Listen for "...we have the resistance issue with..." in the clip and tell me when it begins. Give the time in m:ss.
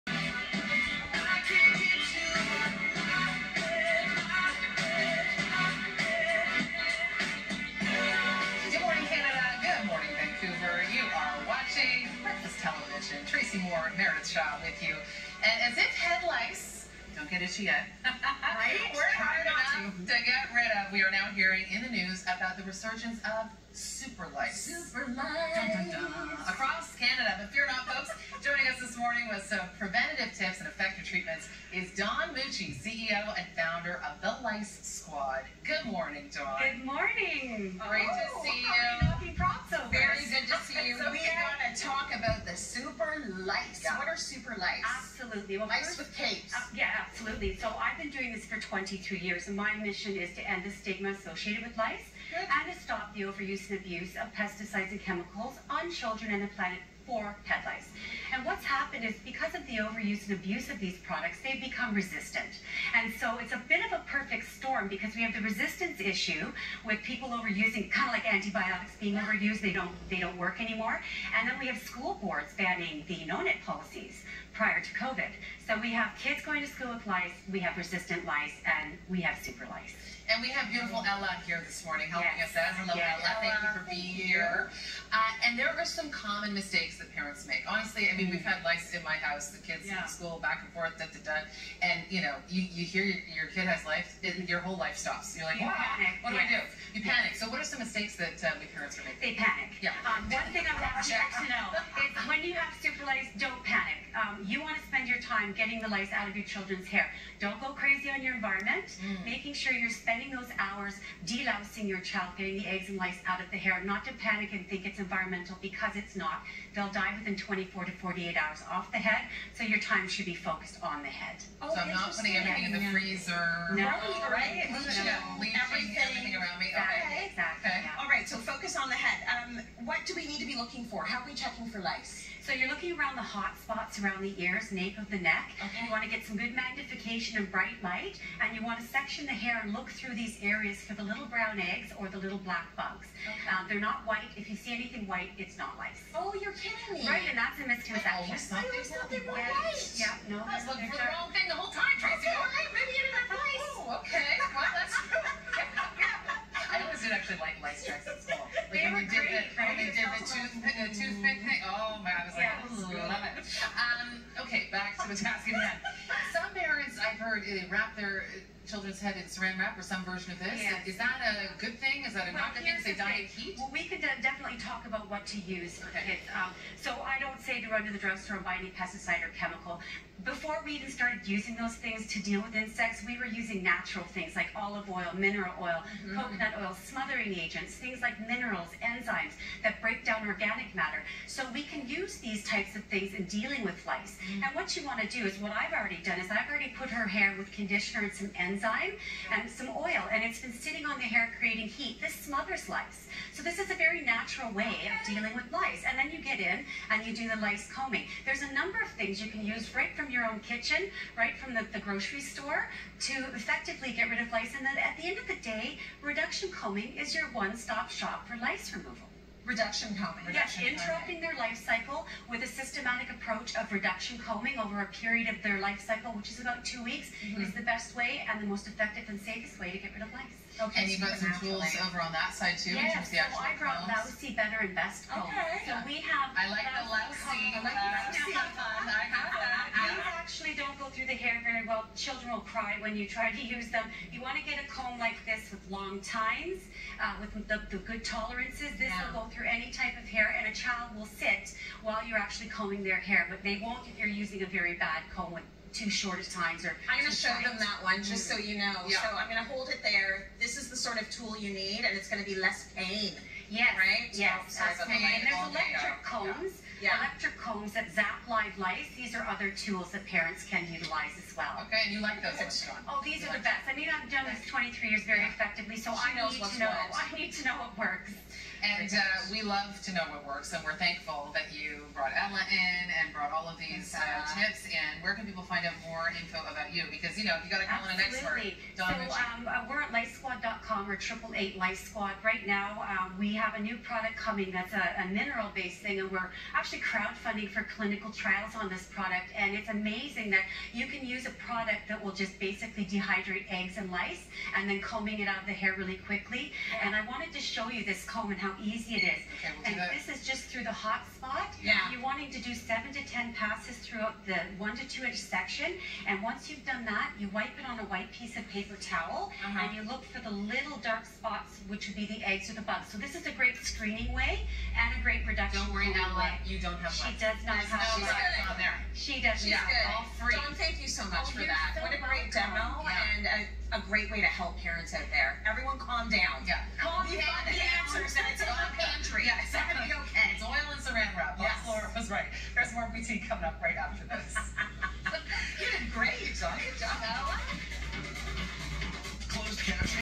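1:05.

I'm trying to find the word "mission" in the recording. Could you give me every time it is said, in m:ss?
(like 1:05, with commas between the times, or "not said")
0:49.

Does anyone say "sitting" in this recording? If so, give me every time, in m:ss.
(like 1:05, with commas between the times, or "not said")
3:20.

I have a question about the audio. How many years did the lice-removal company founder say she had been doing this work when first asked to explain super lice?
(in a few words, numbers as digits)
22.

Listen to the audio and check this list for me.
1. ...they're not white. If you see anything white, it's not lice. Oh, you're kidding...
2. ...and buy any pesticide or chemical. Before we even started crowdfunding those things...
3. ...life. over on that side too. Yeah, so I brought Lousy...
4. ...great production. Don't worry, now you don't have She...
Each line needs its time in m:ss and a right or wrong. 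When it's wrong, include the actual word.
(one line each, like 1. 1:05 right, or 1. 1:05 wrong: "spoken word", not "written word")
1. 2:23 right
2. 2:58 wrong: "using", not "crowdfunding"
3. 3:51 right
4. 5:25 right.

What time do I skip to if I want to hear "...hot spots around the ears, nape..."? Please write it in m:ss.
2:13.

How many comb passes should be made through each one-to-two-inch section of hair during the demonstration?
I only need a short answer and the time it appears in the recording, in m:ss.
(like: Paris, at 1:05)
7 to 10, at 5:12.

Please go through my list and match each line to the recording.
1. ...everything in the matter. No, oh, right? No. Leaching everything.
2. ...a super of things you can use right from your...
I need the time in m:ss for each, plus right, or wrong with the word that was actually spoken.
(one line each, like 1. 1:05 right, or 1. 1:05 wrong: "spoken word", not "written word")
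1. 2:02 wrong: "freezer", not "matter"
2. 3:28 wrong: "number", not "super".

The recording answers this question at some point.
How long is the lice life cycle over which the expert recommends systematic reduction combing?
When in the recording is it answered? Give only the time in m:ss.
3:46.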